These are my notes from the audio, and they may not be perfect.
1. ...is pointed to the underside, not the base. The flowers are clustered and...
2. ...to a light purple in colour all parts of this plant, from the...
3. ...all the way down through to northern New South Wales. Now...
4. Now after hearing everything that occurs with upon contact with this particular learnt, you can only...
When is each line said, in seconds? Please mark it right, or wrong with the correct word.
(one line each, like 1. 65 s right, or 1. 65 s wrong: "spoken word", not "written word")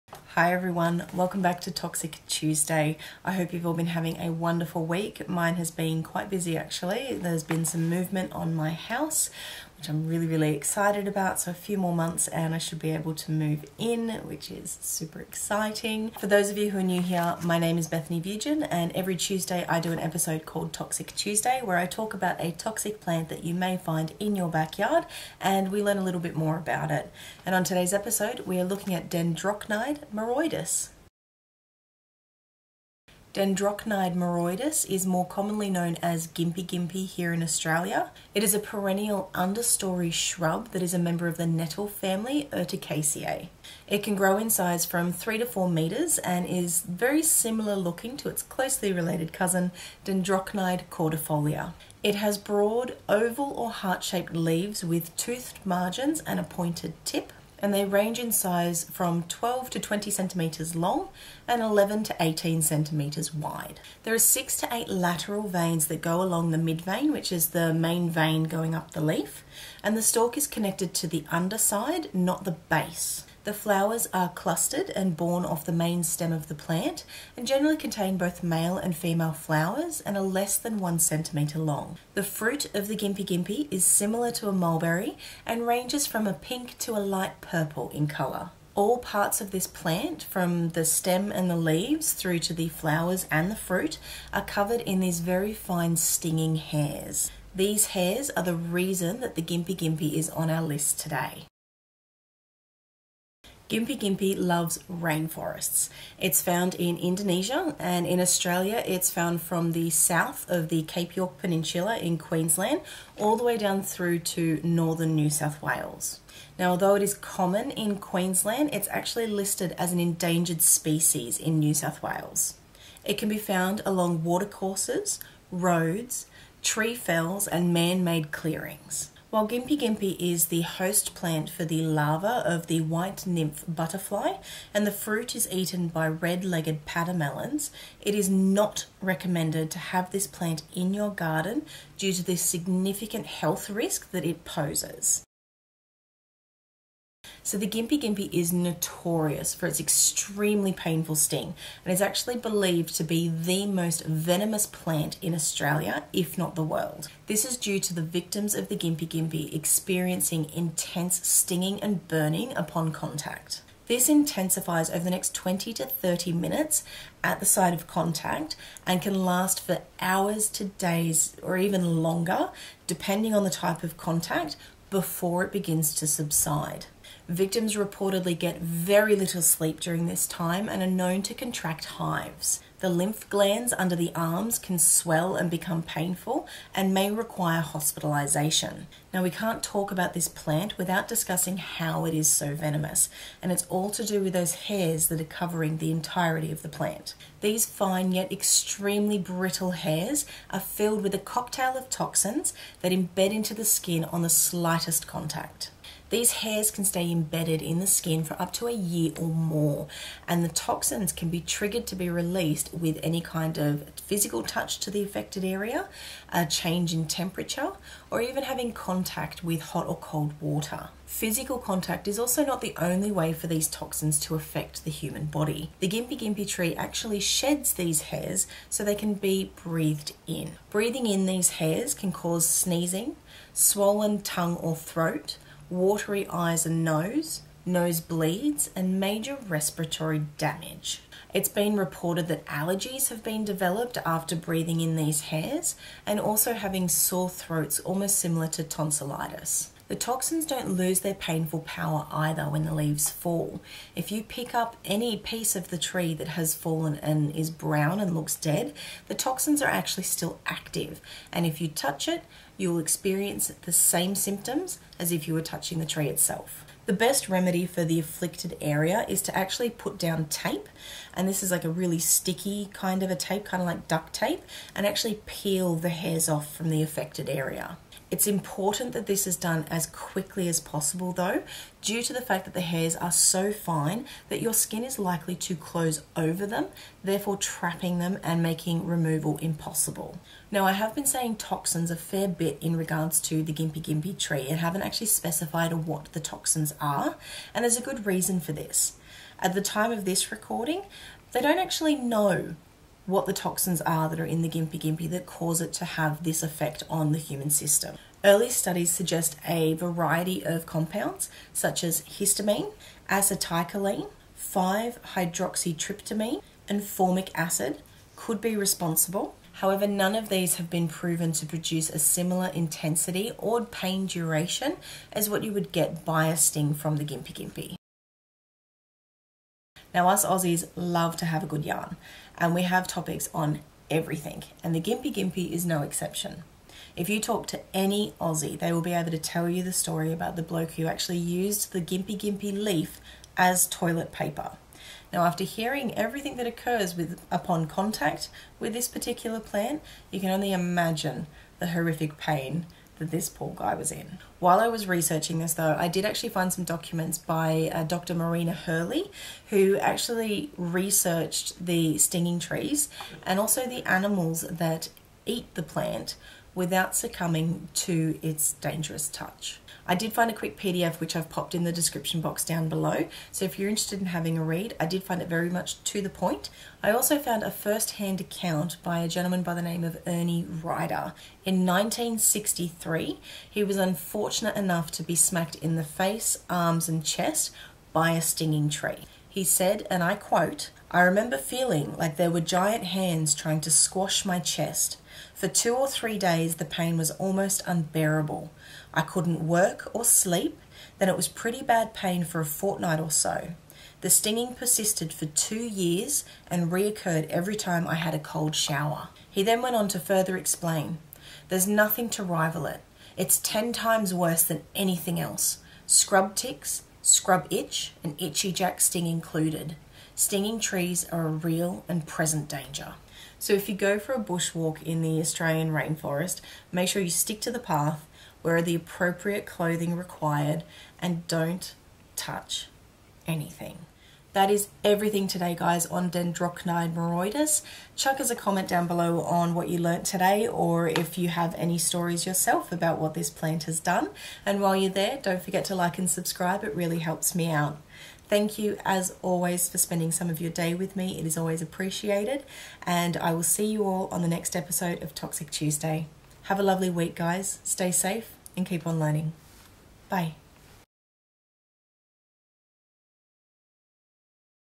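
1. 70 s wrong: "connected", not "pointed"
2. 86 s right
3. 113 s right
4. 345 s wrong: "plant", not "learnt".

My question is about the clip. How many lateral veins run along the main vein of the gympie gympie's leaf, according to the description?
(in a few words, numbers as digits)
6 to 8.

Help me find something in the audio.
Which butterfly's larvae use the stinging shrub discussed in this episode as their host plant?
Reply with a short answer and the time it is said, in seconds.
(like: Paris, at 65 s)
white nymph butterfly, at 132 s.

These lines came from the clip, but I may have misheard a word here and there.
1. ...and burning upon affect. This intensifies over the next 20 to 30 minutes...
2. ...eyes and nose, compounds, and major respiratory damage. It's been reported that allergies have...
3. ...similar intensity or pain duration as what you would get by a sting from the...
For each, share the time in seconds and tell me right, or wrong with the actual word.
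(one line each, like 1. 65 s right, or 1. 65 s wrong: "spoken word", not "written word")
1. 161 s wrong: "contact", not "affect"
2. 236 s wrong: "nosebleeds", not "compounds"
3. 321 s right.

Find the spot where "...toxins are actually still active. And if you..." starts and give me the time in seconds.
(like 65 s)
259 s.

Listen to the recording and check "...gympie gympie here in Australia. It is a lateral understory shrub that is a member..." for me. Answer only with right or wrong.
wrong.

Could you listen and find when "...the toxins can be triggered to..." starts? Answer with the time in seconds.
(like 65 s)
210 s.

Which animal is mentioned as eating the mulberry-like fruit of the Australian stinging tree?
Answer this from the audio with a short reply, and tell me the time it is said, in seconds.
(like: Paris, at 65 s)
red-legged pademelons, at 136 s.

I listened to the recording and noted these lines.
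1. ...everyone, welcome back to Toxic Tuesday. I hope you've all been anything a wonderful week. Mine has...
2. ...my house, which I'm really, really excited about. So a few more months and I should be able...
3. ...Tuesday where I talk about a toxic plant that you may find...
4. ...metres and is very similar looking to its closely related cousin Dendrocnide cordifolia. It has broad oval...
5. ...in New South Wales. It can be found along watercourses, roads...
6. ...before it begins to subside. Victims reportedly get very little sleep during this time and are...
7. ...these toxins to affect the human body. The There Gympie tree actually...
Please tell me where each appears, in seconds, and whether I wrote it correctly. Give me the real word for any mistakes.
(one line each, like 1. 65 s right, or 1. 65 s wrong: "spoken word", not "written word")
1. 0 s wrong: "having", not "anything"
2. 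8 s right
3. 21 s right
4. 45 s right
5. 121 s right
6. 174 s right
7. 223 s wrong: "Gympie", not "There".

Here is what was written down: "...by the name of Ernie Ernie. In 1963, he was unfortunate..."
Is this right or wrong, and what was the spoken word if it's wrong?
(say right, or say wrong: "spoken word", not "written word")
wrong: "Ryder", not "Ernie".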